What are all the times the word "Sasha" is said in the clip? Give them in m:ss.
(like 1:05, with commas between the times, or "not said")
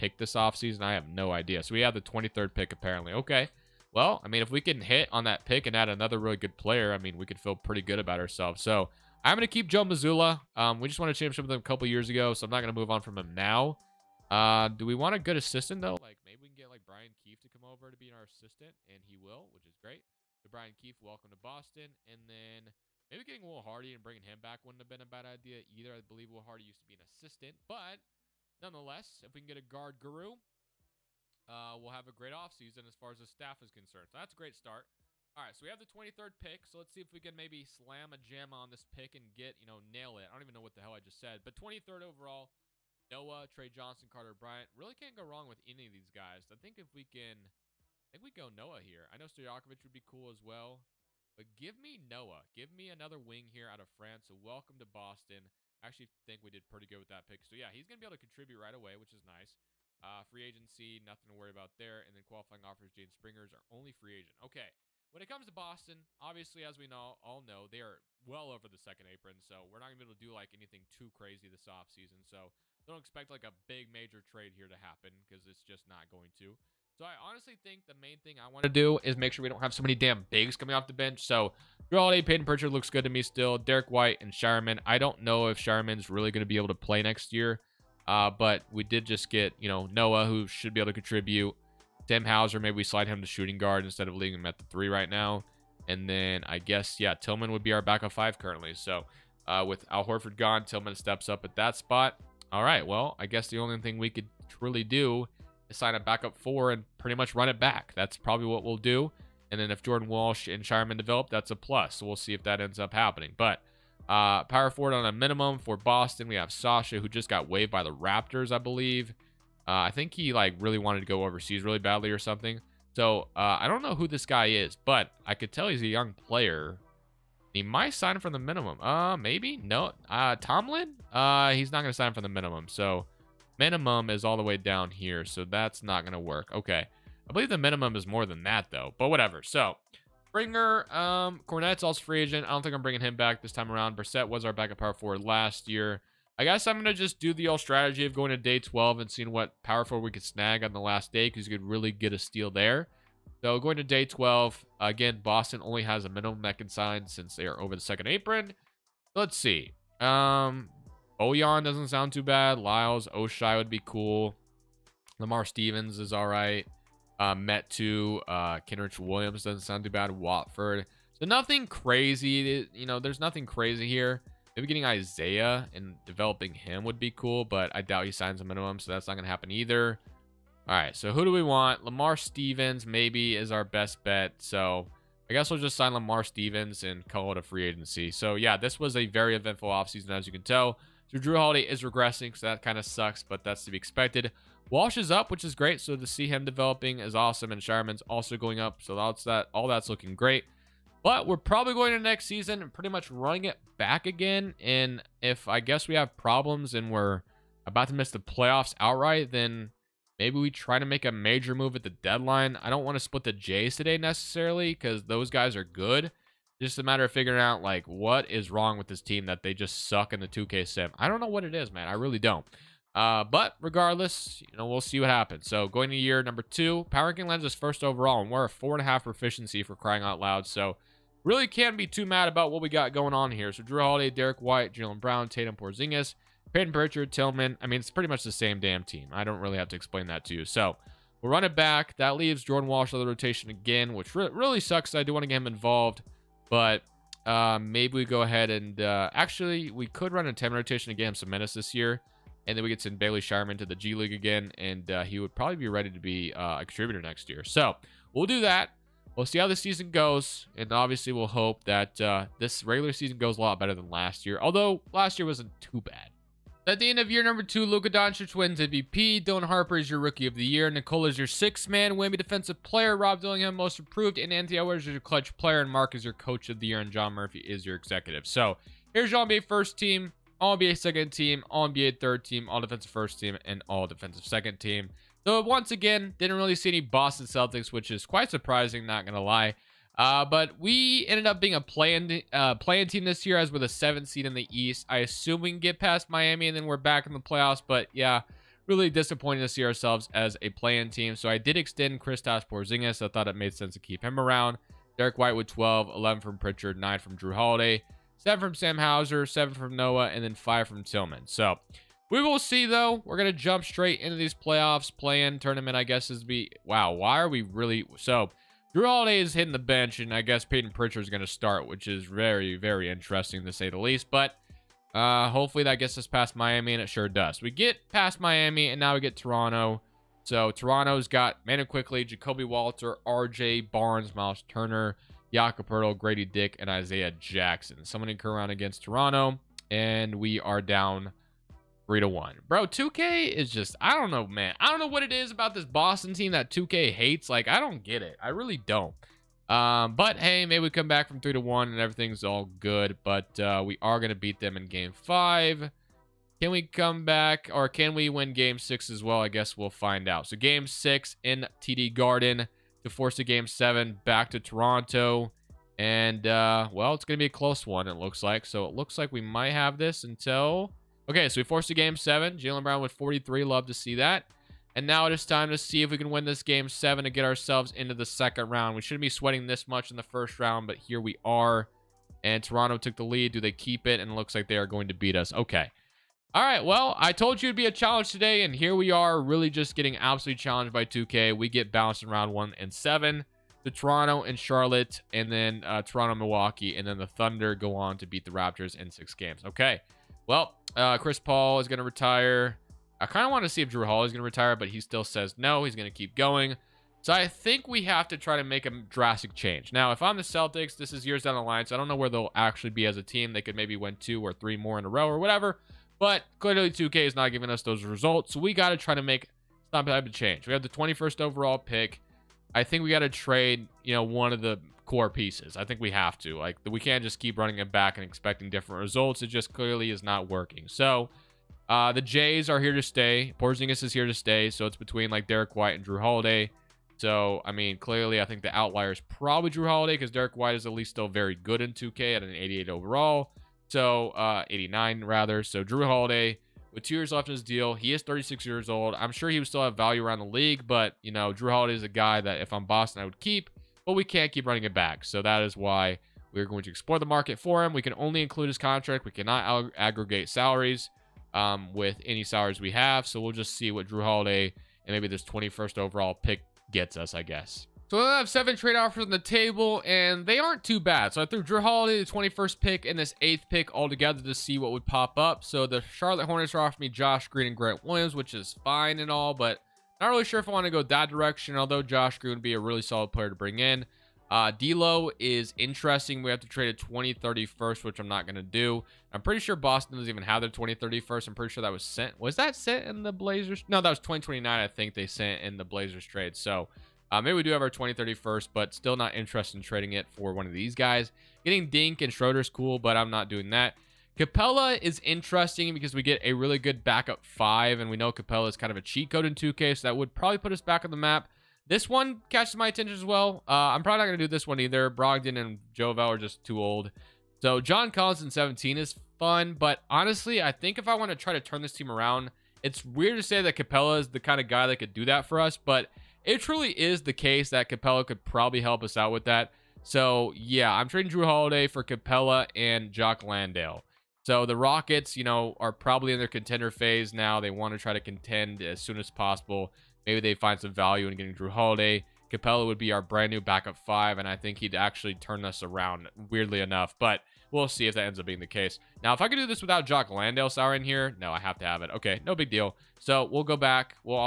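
1:56.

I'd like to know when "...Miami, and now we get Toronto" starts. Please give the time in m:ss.
5:28.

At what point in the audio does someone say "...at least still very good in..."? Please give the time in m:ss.
7:20.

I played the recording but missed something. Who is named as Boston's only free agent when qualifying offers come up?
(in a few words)
Jaden Springer.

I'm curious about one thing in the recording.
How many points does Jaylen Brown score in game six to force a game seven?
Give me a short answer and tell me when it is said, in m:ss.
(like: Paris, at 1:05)
43, at 6:12.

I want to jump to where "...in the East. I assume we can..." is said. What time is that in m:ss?
4:54.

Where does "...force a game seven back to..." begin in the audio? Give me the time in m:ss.
6:02.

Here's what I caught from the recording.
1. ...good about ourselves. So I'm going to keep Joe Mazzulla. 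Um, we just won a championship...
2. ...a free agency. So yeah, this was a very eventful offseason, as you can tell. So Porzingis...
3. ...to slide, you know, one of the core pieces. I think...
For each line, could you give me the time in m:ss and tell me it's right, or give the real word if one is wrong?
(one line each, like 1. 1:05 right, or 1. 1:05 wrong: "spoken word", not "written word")
1. 0:07 right
2. 3:07 wrong: "Jrue", not "Porzingis"
3. 7:02 wrong: "trade", not "slide".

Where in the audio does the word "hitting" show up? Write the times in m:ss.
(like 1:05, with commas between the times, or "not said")
5:19.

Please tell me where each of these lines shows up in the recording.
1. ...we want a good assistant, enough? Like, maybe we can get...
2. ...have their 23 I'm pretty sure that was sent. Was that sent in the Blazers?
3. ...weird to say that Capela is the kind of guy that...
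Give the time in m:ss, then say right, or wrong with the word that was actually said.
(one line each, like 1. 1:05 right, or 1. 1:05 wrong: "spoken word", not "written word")
1. 0:14 wrong: "though", not "enough"
2. 8:10 wrong: "20", not "23"
3. 8:42 right.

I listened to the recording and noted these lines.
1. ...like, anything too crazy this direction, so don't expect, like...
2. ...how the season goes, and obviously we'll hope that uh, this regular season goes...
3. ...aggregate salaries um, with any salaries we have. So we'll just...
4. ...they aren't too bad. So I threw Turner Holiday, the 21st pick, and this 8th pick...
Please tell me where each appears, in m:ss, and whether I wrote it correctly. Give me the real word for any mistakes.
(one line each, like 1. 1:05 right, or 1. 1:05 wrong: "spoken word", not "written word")
1. 1:10 wrong: "offseason", not "direction"
2. 4:19 right
3. 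7:39 right
4. 7:50 wrong: "Jrue", not "Turner".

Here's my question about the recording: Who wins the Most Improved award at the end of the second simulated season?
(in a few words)
Rob Dillingham.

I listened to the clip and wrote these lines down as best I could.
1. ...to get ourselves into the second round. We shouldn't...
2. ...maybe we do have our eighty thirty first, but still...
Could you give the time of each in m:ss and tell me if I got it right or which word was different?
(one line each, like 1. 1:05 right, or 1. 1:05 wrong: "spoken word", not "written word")
1. 6:17 right
2. 8:17 wrong: "twenty", not "eighty".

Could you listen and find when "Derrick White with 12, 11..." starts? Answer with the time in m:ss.
5:04.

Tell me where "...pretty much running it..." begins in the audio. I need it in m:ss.
3:22.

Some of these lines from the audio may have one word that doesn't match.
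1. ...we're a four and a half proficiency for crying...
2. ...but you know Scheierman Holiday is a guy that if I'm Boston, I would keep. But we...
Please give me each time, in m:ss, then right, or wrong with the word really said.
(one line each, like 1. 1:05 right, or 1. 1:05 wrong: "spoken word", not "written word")
1. 3:48 right
2. 7:30 wrong: "Jrue", not "Scheierman".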